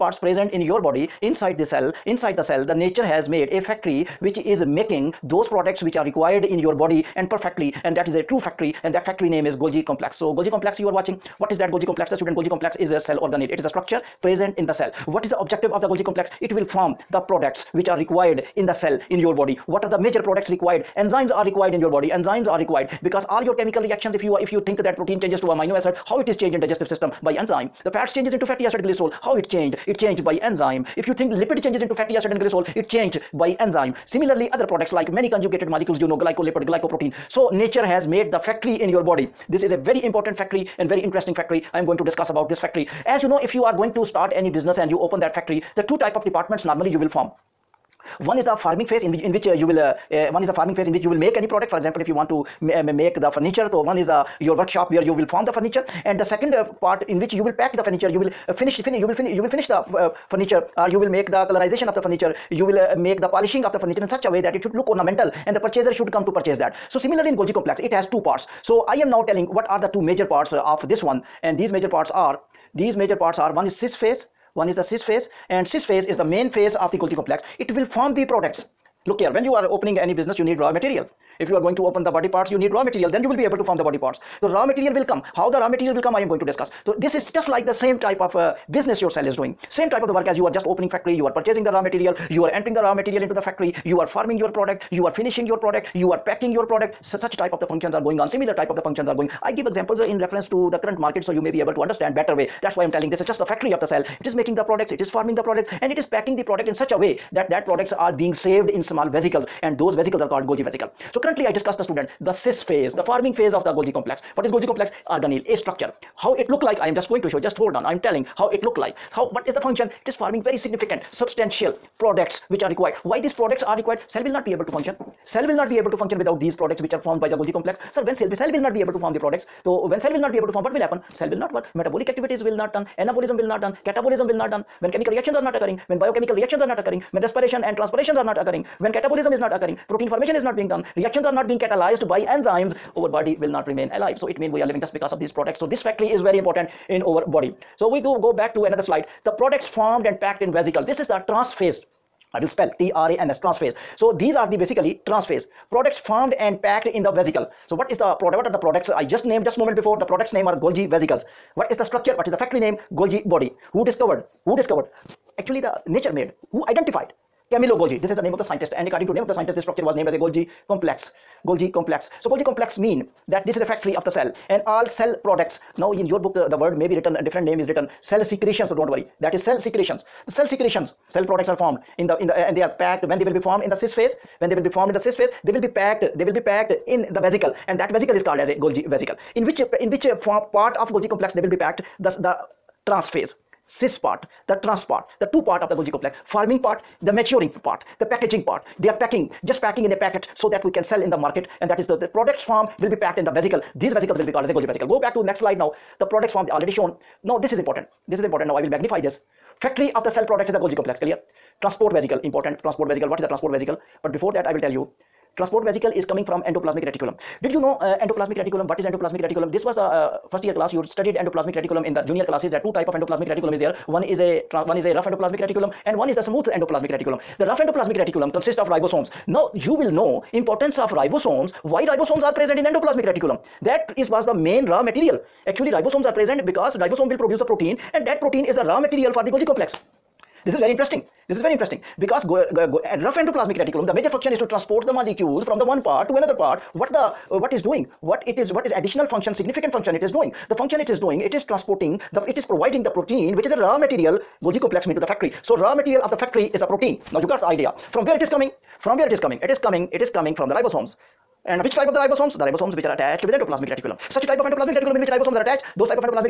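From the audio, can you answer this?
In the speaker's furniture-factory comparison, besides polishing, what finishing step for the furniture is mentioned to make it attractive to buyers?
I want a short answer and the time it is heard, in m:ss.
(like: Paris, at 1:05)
colorization, at 1:01.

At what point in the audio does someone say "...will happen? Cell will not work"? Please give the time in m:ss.
2:10.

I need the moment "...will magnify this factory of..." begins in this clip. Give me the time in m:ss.
3:28.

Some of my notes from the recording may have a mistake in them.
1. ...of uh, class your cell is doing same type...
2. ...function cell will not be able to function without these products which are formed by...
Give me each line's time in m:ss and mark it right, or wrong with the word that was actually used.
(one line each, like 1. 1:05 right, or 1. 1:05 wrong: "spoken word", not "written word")
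1. 1:28 wrong: "business", not "class"
2. 2:04 right.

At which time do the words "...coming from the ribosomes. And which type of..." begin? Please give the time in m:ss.
4:20.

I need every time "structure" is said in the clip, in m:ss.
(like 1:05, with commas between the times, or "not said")
0:13, 1:55, 2:41, 2:49.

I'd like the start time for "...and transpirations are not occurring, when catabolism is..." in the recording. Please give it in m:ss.
2:17.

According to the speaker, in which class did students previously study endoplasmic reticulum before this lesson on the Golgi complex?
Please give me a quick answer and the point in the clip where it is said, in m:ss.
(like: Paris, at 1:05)
first year class, at 3:40.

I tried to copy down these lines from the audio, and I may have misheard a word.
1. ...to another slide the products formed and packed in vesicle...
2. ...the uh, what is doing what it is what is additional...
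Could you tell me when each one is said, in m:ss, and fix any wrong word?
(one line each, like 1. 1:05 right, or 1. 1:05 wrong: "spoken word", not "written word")
1. 2:28 right
2. 4:06 right.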